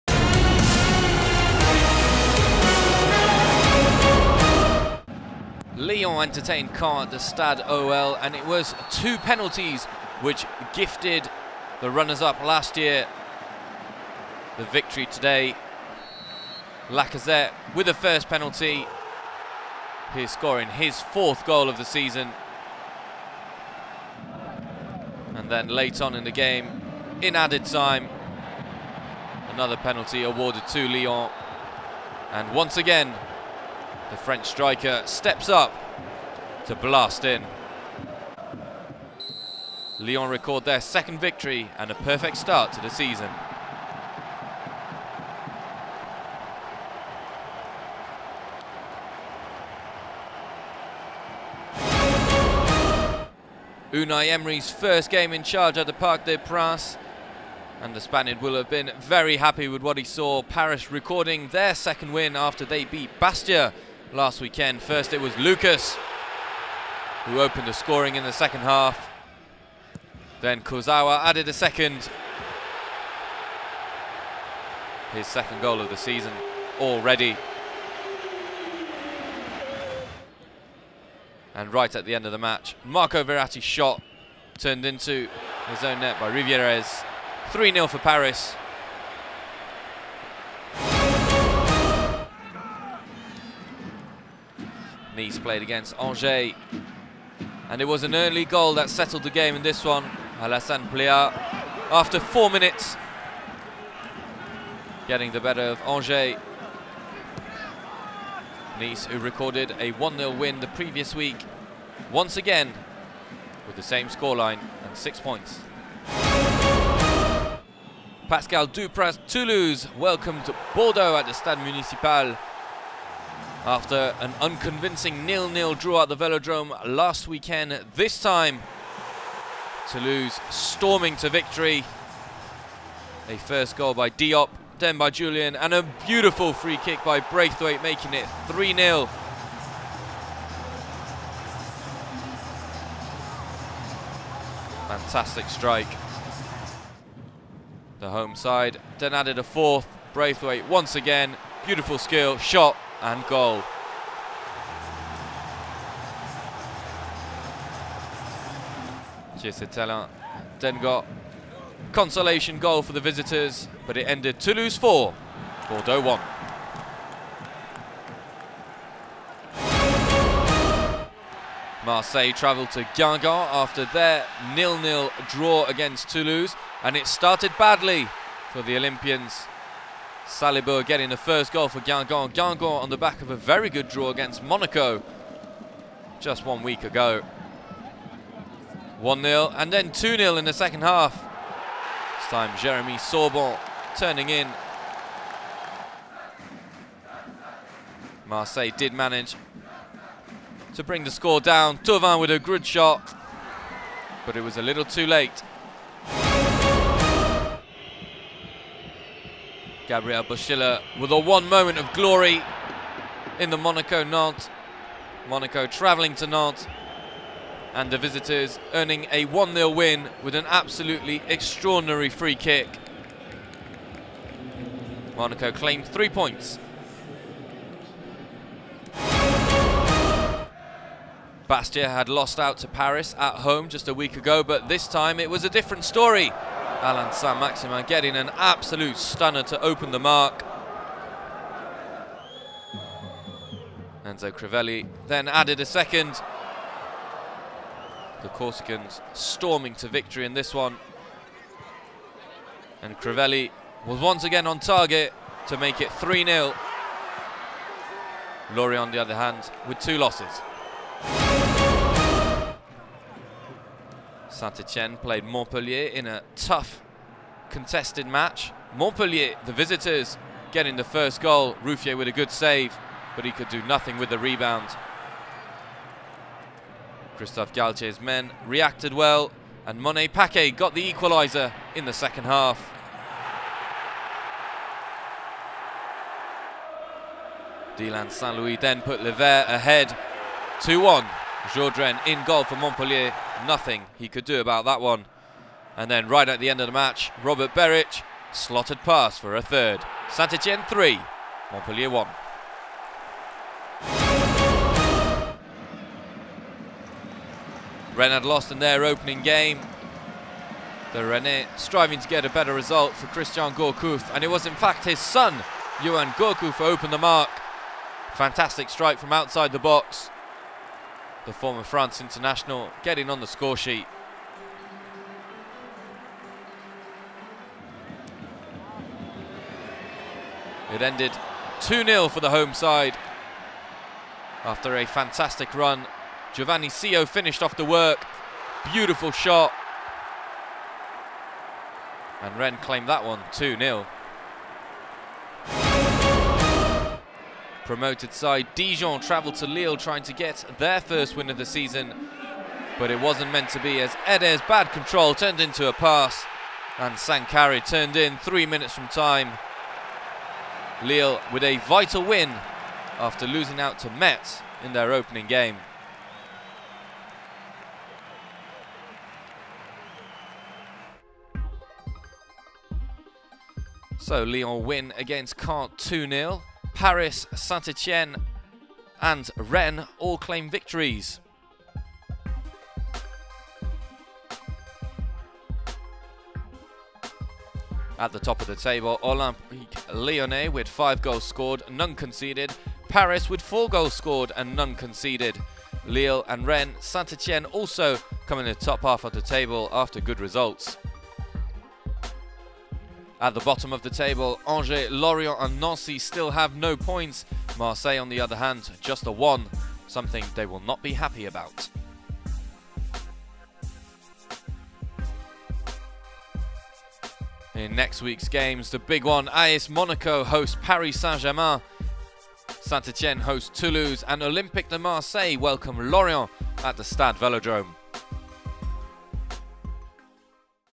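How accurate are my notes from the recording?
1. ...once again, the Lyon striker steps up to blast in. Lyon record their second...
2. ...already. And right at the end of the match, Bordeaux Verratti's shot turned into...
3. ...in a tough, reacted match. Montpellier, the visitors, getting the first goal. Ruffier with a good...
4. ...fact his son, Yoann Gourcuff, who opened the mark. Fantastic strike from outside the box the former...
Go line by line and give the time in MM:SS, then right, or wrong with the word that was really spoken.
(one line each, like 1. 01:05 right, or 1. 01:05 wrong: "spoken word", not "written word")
1. 00:32 wrong: "French", not "Lyon"
2. 01:16 wrong: "Marco", not "Bordeaux"
3. 04:25 wrong: "contested", not "reacted"
4. 05:14 right.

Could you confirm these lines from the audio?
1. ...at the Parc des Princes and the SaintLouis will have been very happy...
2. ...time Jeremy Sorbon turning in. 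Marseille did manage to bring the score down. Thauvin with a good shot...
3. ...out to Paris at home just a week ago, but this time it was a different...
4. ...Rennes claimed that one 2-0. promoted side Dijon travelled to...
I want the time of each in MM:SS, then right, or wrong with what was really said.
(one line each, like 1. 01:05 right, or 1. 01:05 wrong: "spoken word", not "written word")
1. 00:55 wrong: "Spaniard", not "SaintLouis"
2. 03:12 right
3. 03:52 right
4. 05:42 right.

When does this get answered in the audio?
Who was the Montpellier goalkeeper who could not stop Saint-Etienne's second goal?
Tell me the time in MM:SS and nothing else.
04:51.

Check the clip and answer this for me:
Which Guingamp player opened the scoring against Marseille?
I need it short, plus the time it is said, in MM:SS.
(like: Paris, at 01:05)
Salibur, at 03:00.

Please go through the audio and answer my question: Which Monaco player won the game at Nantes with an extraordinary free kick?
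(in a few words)
Gabriel Boschilia.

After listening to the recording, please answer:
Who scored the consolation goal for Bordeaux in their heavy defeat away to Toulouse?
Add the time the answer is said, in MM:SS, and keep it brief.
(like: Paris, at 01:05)
Thelin, at 02:39.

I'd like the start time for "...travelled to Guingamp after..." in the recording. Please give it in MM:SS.
02:52.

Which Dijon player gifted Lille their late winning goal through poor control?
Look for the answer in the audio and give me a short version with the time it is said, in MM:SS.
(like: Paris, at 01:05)
Ede, at 05:54.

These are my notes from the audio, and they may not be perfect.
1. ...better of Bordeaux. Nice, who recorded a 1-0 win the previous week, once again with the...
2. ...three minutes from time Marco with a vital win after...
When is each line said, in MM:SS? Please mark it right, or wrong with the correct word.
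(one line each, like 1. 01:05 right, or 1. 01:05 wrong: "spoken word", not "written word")
1. 01:45 wrong: "Angers", not "Bordeaux"
2. 05:58 wrong: "Lille", not "Marco".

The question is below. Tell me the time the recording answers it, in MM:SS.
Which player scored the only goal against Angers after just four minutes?
01:40.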